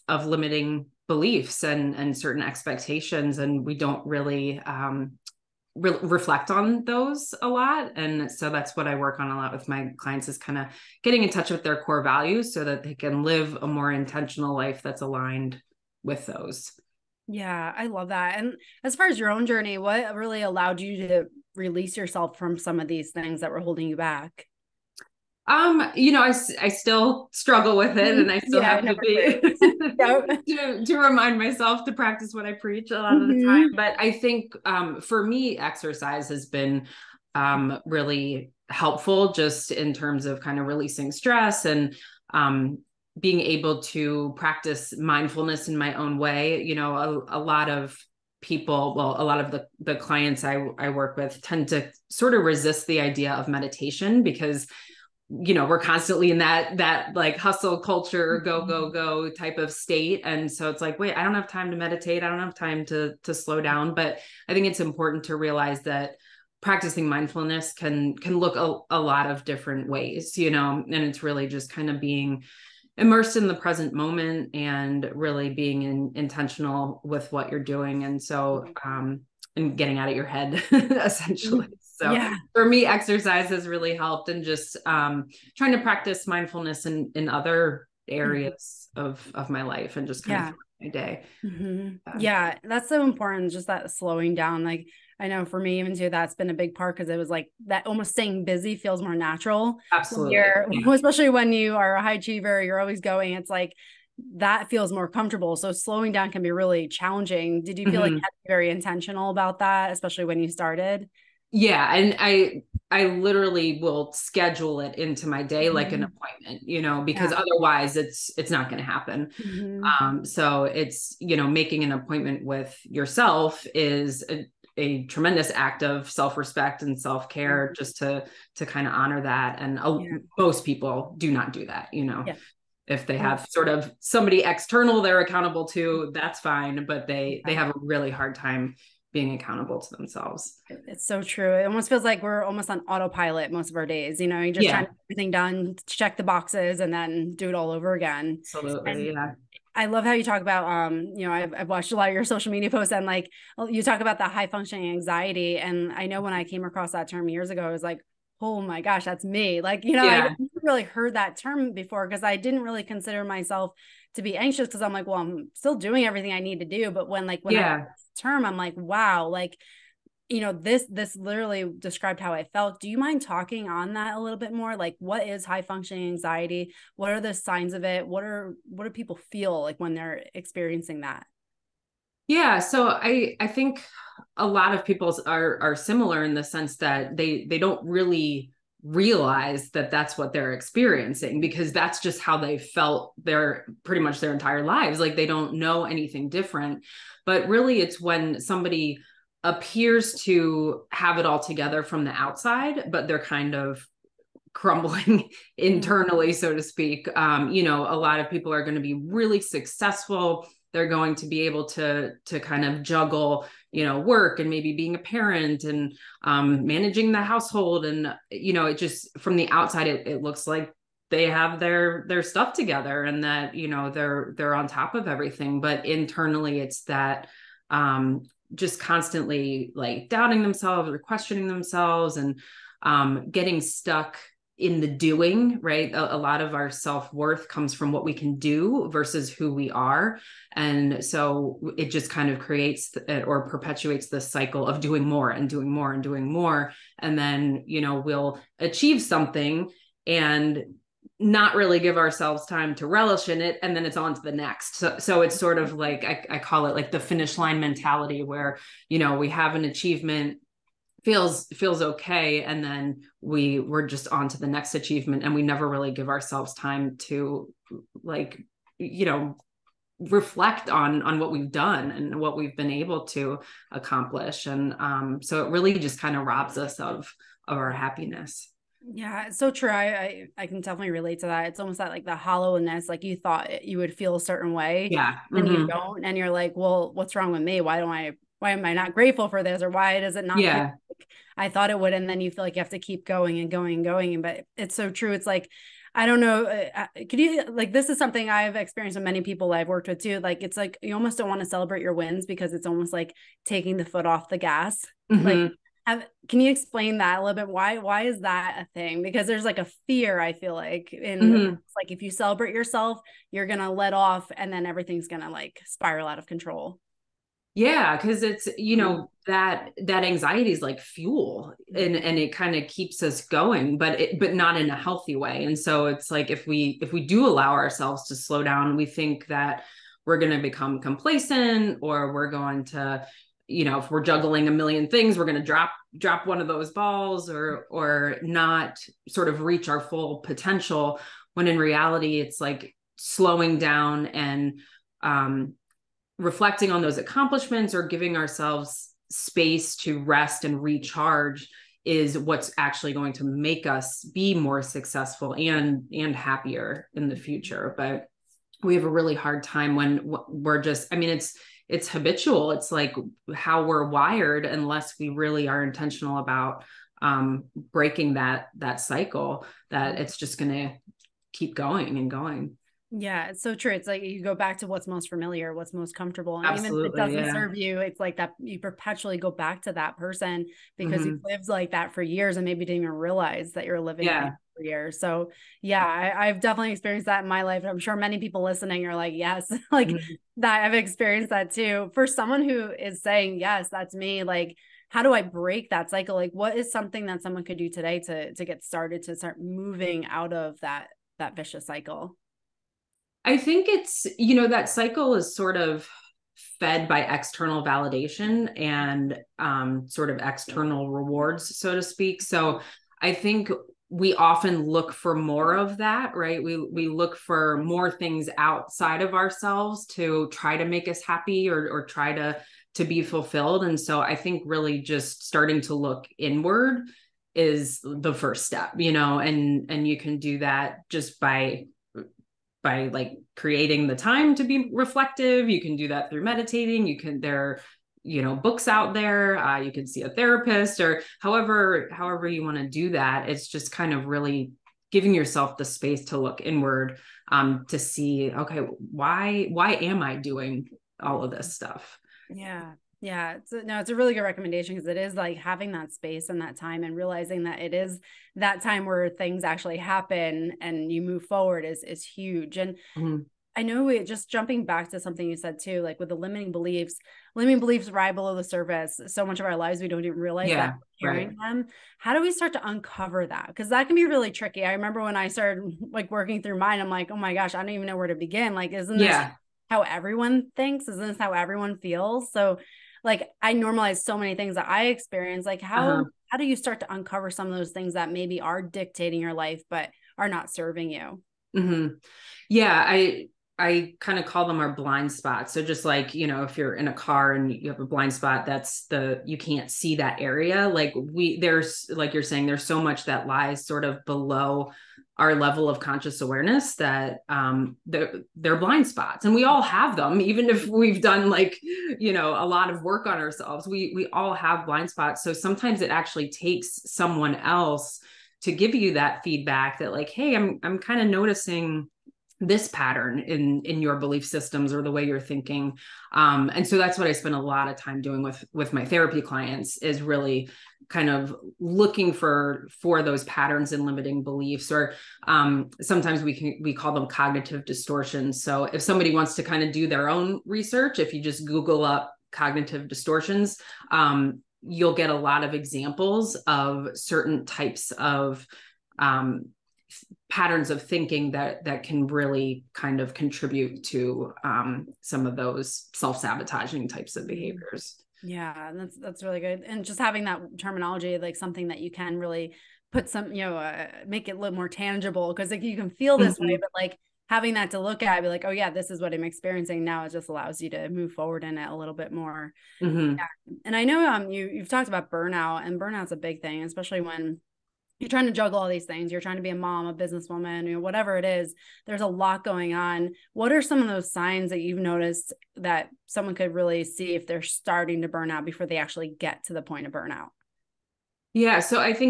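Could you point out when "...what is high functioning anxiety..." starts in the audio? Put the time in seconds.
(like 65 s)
174 s.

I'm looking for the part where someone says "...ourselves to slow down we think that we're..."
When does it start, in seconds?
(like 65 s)
327 s.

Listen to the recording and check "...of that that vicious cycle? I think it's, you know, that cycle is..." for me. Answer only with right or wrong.
right.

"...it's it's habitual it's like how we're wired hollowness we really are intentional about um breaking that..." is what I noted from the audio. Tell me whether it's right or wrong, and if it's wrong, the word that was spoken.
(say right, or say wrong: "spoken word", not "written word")
wrong: "unless", not "hollowness".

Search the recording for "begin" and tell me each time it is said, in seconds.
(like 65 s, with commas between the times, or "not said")
478 s.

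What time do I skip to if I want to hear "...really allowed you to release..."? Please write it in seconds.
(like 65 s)
20 s.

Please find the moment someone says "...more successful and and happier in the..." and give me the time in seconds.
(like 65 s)
354 s.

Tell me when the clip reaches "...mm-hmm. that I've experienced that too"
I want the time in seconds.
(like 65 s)
389 s.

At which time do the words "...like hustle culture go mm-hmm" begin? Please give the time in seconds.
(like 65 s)
57 s.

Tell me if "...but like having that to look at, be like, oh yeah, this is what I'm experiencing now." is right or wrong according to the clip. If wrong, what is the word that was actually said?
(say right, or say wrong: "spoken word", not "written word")
right.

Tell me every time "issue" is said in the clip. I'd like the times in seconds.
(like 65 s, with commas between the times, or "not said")
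not said.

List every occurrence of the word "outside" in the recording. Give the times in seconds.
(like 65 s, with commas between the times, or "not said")
202 s, 219 s, 418 s.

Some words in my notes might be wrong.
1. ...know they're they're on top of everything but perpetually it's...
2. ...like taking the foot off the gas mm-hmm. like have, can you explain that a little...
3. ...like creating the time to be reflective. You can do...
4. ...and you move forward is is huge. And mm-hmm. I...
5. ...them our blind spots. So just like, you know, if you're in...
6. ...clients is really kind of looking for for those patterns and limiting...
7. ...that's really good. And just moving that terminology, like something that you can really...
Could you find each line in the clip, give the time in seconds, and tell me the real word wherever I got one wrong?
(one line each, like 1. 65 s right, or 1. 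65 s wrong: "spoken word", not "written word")
1. 223 s wrong: "internally", not "perpetually"
2. 302 s right
3. 432 s right
4. 460 s right
5. 494 s right
6. 529 s right
7. 558 s wrong: "having", not "moving".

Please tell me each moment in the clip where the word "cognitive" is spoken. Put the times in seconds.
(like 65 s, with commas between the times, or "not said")
537 s, 542 s.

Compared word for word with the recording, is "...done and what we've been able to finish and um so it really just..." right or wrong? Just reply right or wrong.
wrong.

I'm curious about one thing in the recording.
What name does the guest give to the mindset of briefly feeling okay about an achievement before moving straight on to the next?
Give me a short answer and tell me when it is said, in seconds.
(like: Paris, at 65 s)
finish line mentality, at 256 s.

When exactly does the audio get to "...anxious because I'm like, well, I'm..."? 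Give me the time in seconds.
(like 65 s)
164 s.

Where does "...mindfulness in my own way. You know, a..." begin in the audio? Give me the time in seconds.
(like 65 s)
44 s.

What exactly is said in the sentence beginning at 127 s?
just to to kind of honor that and a, yeah.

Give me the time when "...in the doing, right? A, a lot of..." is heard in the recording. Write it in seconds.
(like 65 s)
234 s.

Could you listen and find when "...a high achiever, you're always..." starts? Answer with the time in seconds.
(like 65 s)
101 s.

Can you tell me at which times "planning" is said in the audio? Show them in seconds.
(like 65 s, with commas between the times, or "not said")
not said.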